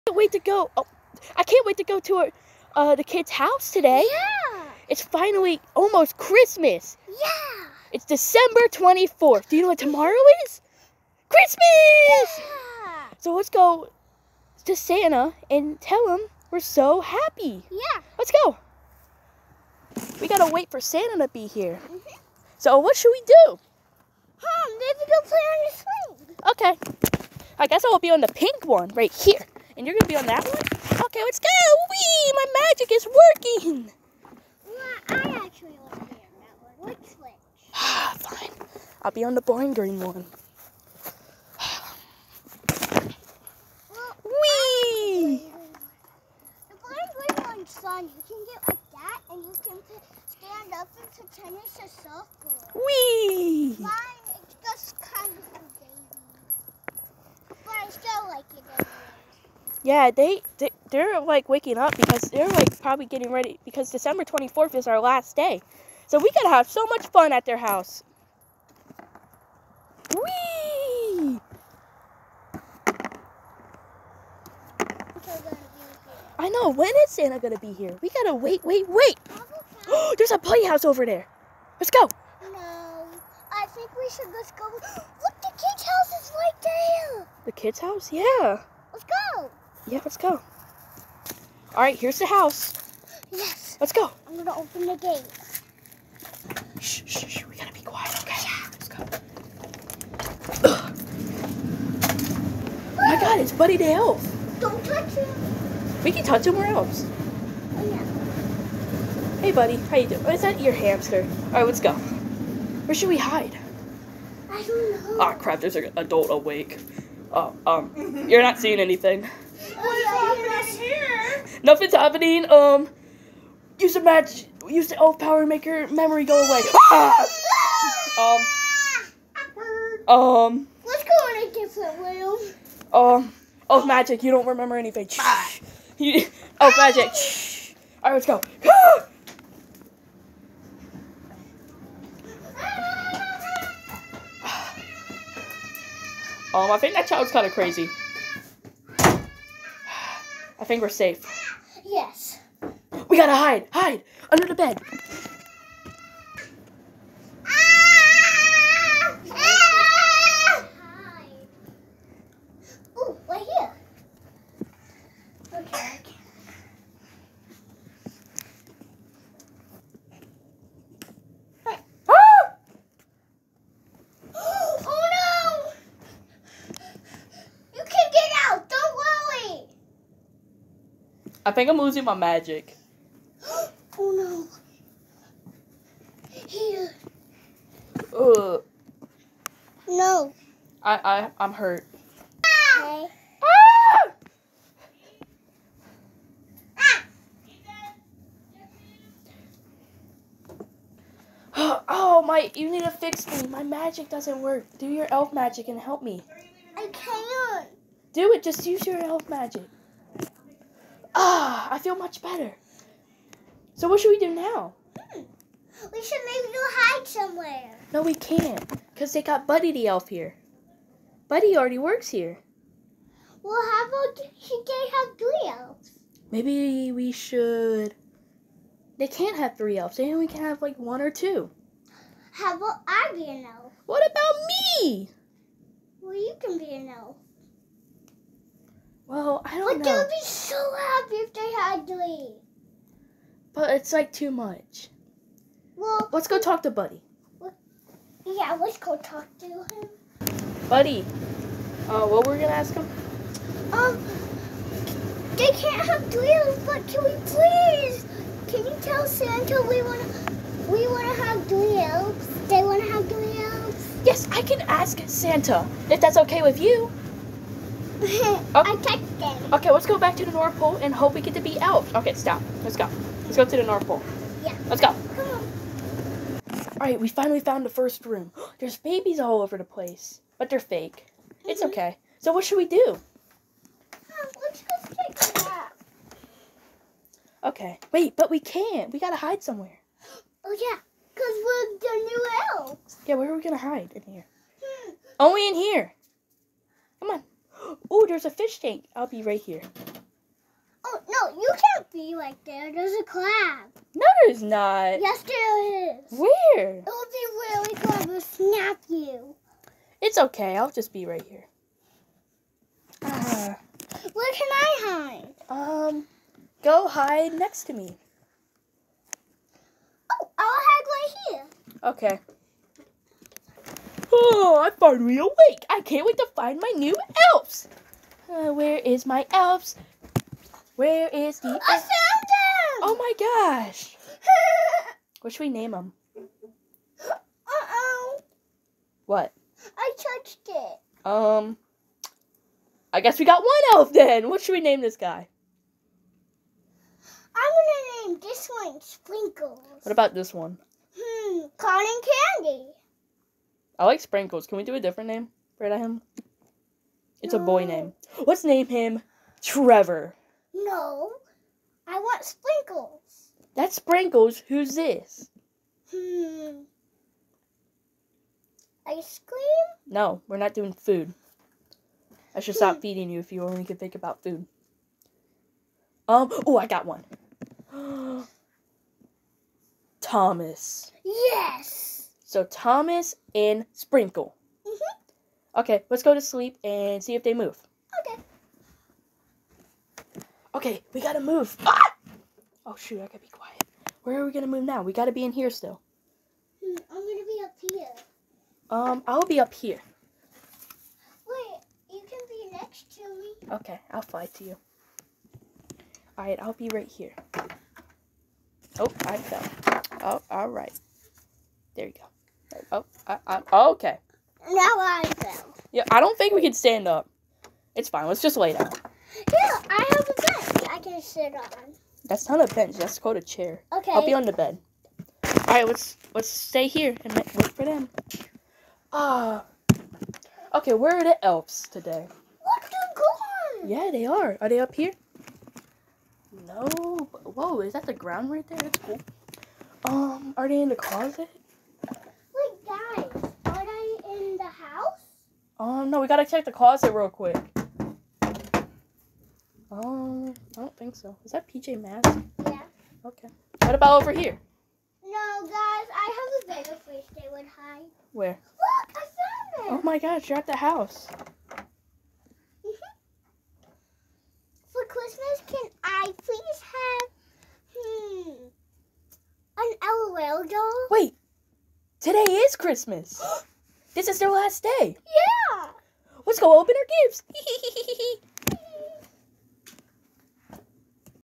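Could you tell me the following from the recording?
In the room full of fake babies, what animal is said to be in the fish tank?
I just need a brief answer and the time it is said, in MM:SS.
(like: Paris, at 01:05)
crab, at 05:03.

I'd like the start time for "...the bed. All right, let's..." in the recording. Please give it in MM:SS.
07:04.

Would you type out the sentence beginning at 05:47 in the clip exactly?
I'm gonna name this one Sprinkles.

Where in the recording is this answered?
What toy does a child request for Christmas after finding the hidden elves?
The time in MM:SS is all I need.
07:49.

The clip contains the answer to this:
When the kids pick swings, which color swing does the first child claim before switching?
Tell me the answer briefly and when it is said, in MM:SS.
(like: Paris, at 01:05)
pink, at 00:28.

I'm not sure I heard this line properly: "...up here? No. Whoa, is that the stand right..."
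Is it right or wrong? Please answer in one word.
wrong.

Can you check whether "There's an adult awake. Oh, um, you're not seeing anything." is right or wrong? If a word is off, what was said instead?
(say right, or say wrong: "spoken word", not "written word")
right.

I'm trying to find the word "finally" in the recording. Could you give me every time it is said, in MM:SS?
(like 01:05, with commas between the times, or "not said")
00:05, 04:37, 05:24.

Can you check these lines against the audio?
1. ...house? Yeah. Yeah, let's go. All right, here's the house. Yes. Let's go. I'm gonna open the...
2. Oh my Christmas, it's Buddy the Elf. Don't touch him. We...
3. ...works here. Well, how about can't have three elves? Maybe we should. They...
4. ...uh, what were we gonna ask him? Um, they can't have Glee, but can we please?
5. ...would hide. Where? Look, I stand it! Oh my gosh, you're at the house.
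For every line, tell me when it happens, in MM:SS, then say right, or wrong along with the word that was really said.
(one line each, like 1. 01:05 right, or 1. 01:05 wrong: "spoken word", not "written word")
1. 01:27 right
2. 01:42 wrong: "God", not "Christmas"
3. 03:41 right
4. 04:11 right
5. 07:37 wrong: "found", not "stand".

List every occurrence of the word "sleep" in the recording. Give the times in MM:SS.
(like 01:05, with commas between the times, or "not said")
06:26.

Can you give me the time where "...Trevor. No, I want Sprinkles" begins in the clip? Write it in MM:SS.
05:59.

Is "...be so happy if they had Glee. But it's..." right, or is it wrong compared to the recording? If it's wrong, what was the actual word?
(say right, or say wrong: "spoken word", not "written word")
right.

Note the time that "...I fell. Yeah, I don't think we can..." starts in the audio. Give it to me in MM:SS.
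06:54.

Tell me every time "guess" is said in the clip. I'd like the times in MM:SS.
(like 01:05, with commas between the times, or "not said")
00:27, 05:43.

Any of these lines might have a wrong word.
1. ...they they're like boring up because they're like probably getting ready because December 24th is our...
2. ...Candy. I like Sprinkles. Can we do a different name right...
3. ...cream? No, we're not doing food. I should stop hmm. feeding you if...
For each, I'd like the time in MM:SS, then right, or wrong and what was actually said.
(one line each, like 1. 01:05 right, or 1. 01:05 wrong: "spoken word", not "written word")
1. 01:00 wrong: "waking", not "boring"
2. 05:52 right
3. 06:09 right.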